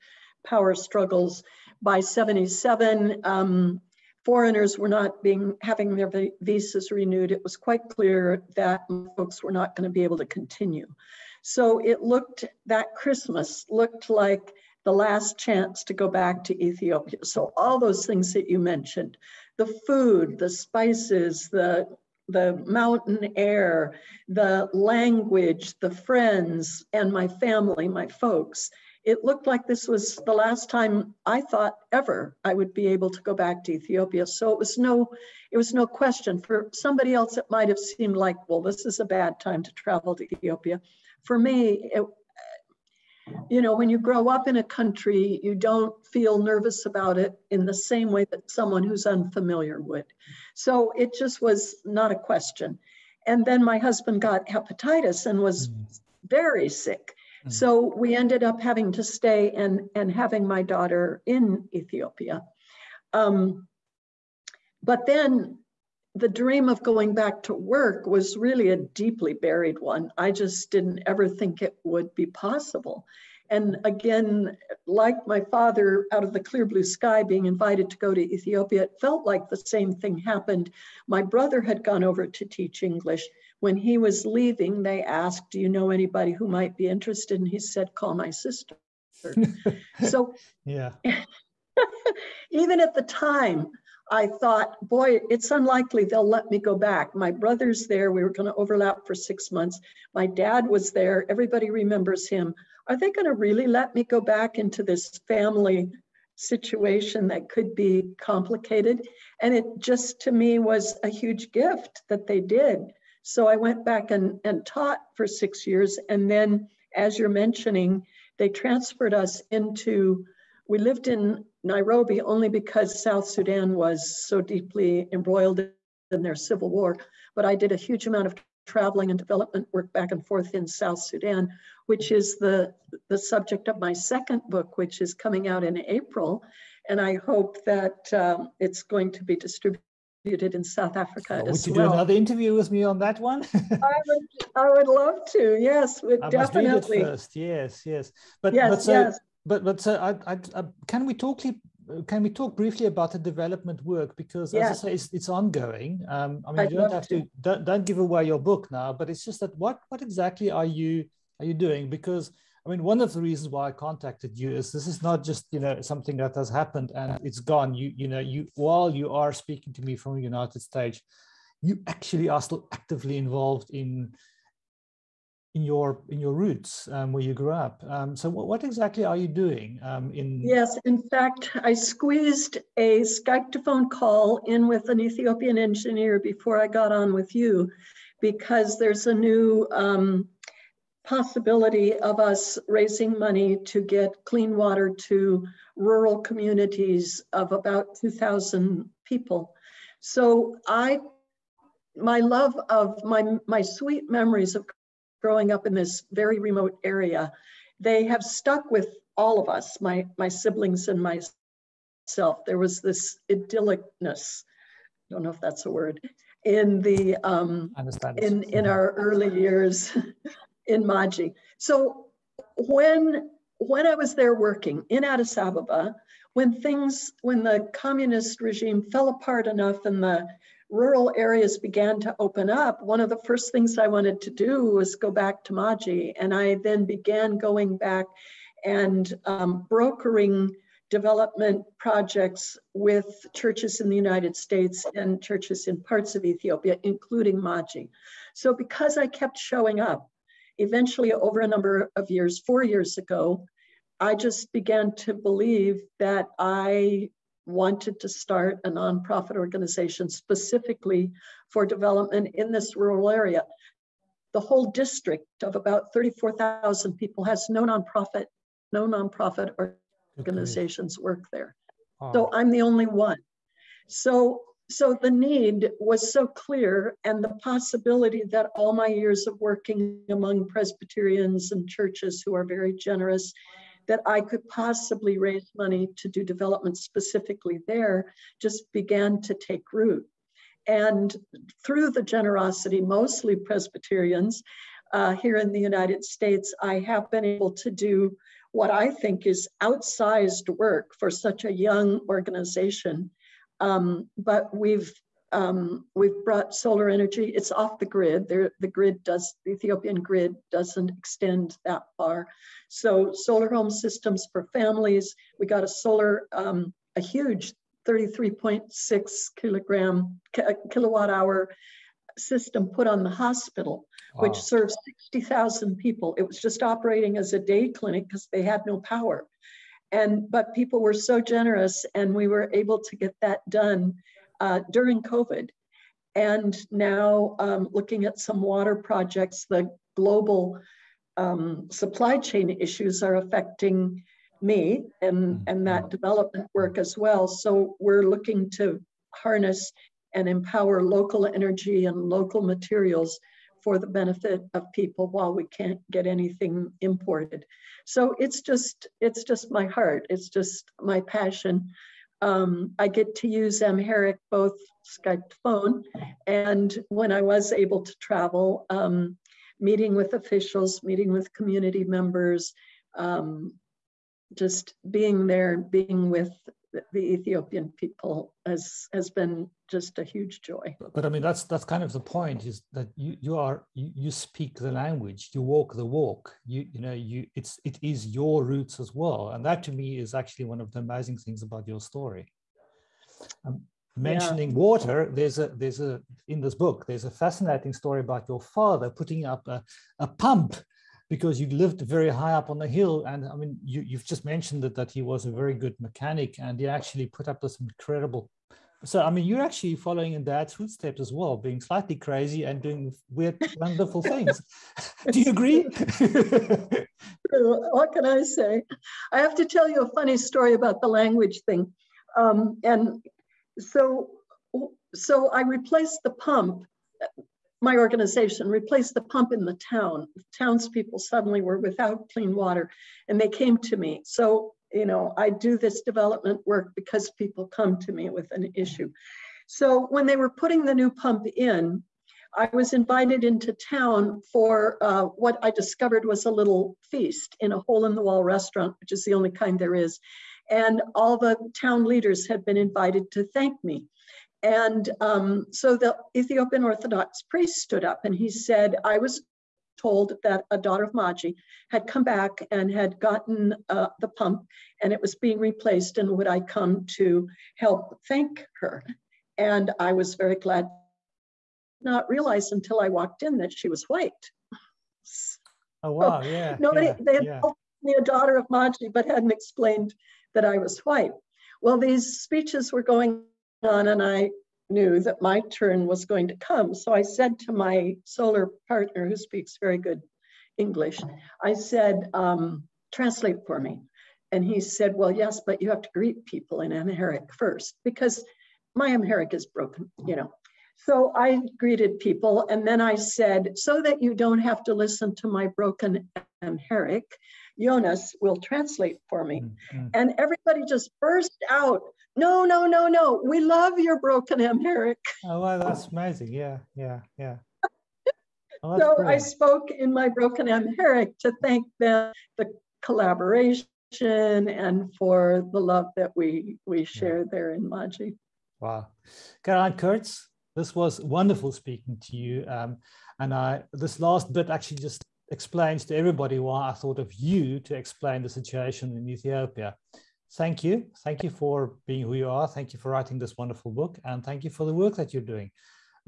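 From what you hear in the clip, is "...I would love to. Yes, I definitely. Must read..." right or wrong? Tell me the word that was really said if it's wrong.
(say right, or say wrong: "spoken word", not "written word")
right.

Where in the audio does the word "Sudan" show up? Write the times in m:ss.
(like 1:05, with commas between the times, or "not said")
2:03, 2:11.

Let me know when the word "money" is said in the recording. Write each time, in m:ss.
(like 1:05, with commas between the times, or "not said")
3:13, 4:45.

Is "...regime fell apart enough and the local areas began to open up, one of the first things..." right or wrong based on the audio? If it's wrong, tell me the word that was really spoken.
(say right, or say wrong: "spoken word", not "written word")
wrong: "rural", not "local".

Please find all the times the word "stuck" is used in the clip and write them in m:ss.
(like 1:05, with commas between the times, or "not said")
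3:28.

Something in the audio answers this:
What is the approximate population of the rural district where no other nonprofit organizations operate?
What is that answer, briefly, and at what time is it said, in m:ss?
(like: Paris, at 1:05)
34,000, at 4:25.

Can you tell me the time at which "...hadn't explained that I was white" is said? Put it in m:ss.
7:59.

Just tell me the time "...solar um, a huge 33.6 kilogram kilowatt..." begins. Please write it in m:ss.
5:15.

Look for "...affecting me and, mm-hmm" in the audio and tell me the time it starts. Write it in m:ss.
5:43.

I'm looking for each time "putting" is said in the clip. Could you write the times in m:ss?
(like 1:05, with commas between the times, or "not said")
6:38, 7:20.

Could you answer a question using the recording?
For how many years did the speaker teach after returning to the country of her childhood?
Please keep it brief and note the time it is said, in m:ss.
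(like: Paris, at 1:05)
6, at 1:55.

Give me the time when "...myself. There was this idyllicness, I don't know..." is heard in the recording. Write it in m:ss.
3:31.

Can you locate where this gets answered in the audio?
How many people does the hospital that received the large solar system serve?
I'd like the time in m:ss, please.
5:25.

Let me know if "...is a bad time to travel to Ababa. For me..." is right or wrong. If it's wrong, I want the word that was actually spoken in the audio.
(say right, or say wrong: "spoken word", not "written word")
wrong: "Ethiopia", not "Ababa".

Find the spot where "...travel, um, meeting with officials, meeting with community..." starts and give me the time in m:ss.
6:07.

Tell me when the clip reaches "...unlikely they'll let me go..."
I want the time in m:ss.
1:35.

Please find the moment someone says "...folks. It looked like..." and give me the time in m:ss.
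0:28.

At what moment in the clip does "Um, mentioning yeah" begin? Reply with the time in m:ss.
6:33.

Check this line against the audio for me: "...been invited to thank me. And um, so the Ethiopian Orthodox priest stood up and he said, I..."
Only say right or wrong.
right.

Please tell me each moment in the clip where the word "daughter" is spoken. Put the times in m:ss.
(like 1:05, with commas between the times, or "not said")
1:00, 7:40, 7:58.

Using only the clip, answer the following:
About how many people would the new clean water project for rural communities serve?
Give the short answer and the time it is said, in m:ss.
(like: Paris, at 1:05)
2,000, at 3:17.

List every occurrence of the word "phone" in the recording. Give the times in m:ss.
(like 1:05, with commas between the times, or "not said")
3:03, 6:05.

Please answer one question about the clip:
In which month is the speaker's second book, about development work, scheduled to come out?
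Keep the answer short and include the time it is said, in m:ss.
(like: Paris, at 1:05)
April, at 2:15.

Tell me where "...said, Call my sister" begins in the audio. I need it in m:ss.
1:27.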